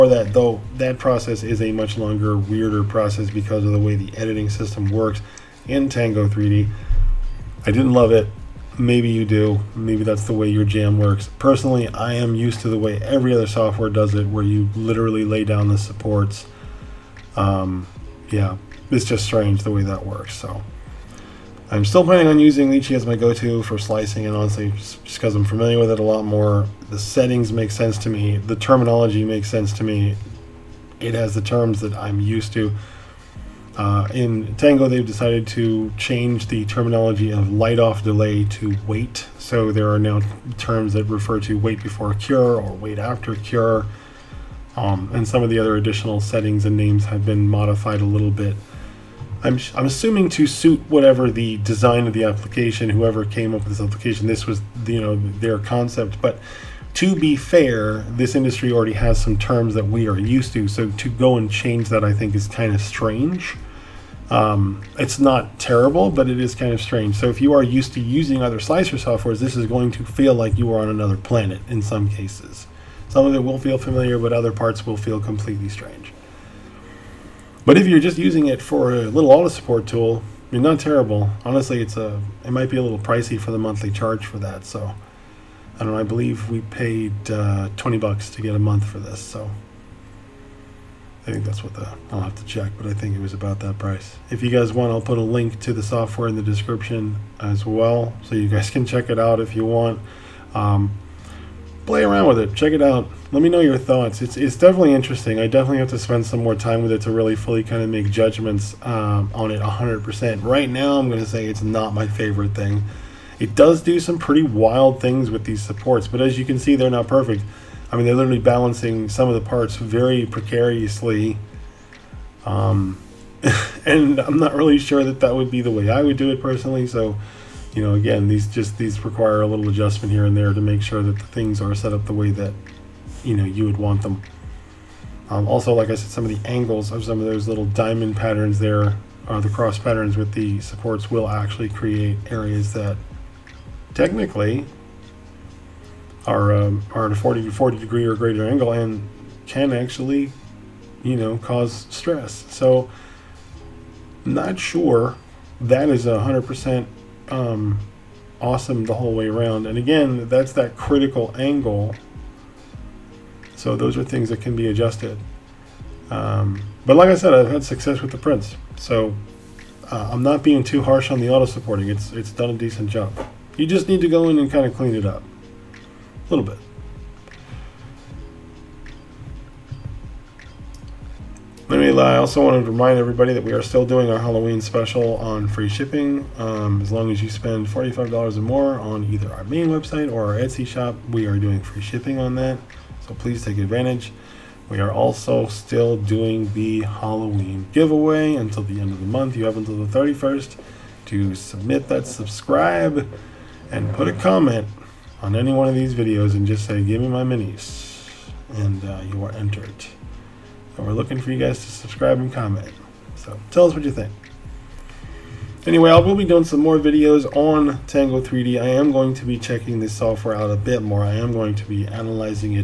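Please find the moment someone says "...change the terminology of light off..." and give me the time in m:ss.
0:35.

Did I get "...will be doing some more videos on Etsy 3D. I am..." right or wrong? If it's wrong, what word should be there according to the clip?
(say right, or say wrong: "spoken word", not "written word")
wrong: "Tango", not "Etsy".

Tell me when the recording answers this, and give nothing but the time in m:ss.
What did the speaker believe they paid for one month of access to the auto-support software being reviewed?
1:27.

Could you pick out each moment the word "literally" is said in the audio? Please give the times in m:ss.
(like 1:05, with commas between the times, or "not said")
0:14, 1:58.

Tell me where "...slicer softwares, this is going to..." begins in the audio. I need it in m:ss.
1:08.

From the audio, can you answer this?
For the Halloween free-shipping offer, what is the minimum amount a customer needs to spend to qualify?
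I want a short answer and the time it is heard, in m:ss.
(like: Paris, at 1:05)
$45, at 3:07.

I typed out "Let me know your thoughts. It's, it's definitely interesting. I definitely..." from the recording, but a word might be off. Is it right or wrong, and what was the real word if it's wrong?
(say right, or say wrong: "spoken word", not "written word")
right.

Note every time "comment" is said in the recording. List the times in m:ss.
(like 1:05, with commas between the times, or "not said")
3:24, 3:32.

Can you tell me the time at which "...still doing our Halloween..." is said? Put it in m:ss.
3:03.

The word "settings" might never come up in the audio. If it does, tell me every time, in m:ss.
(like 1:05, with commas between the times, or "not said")
0:27, 0:46.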